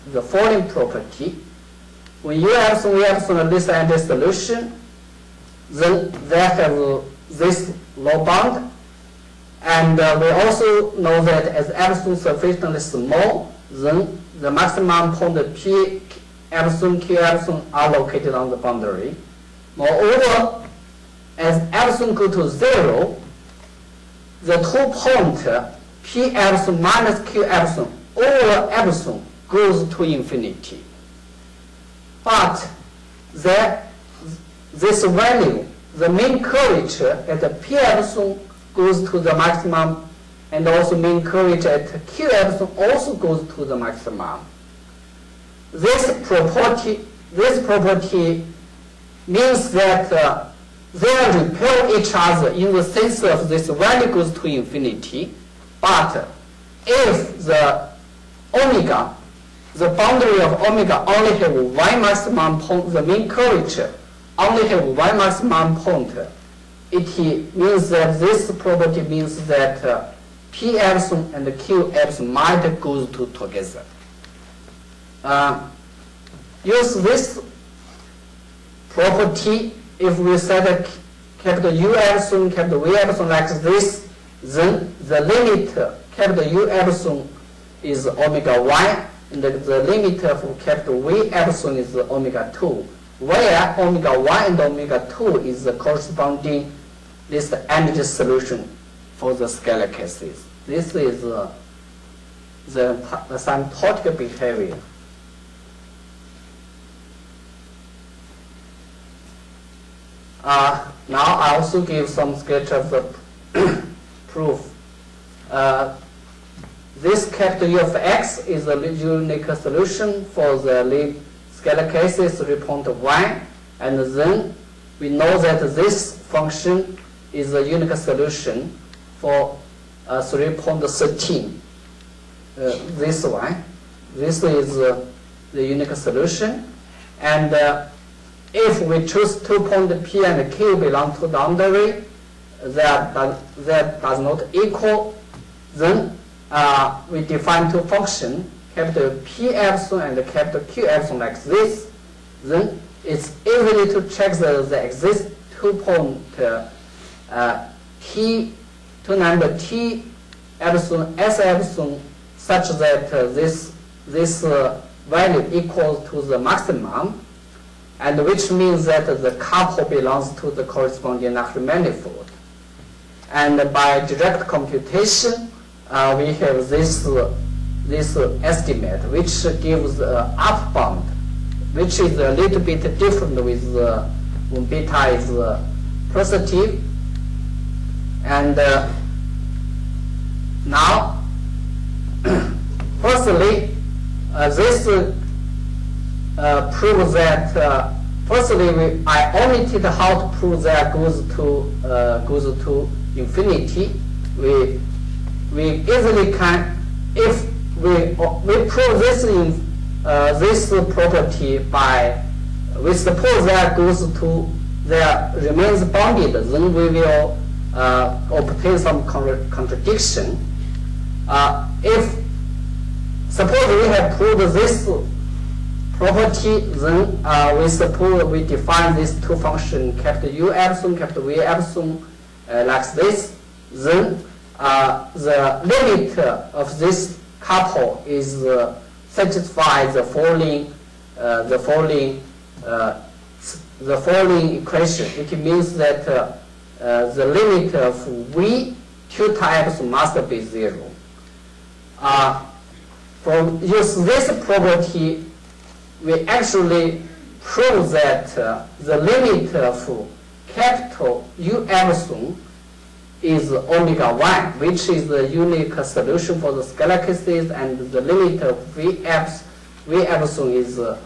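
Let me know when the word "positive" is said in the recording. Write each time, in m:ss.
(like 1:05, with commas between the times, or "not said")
3:06.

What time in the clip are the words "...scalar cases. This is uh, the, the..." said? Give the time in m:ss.
1:39.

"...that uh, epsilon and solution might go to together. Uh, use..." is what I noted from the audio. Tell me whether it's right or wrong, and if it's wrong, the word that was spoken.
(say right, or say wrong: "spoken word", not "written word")
wrong: "epsilon", not "solution".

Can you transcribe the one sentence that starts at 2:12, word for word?
Uh, this one, this is uh, the unique solution.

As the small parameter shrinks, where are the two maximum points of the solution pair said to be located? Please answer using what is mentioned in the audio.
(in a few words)
On the boundary.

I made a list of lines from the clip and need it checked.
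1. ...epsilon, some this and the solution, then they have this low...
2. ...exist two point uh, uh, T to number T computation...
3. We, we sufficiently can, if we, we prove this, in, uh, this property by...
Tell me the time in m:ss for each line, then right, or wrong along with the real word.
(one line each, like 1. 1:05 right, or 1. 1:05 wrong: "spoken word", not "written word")
1. 0:03 right
2. 2:34 wrong: "epsilon", not "computation"
3. 3:24 wrong: "easily", not "sufficiently".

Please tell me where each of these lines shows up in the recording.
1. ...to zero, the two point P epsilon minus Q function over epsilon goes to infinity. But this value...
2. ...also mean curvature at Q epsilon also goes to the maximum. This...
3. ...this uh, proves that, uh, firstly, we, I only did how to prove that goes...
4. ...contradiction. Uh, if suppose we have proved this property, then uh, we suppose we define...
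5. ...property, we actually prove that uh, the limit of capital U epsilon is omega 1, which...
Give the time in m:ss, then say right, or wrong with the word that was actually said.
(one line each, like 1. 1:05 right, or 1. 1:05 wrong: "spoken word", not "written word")
1. 0:22 wrong: "epsilon", not "function"
2. 0:40 right
3. 3:14 right
4. 3:39 right
5. 4:14 right.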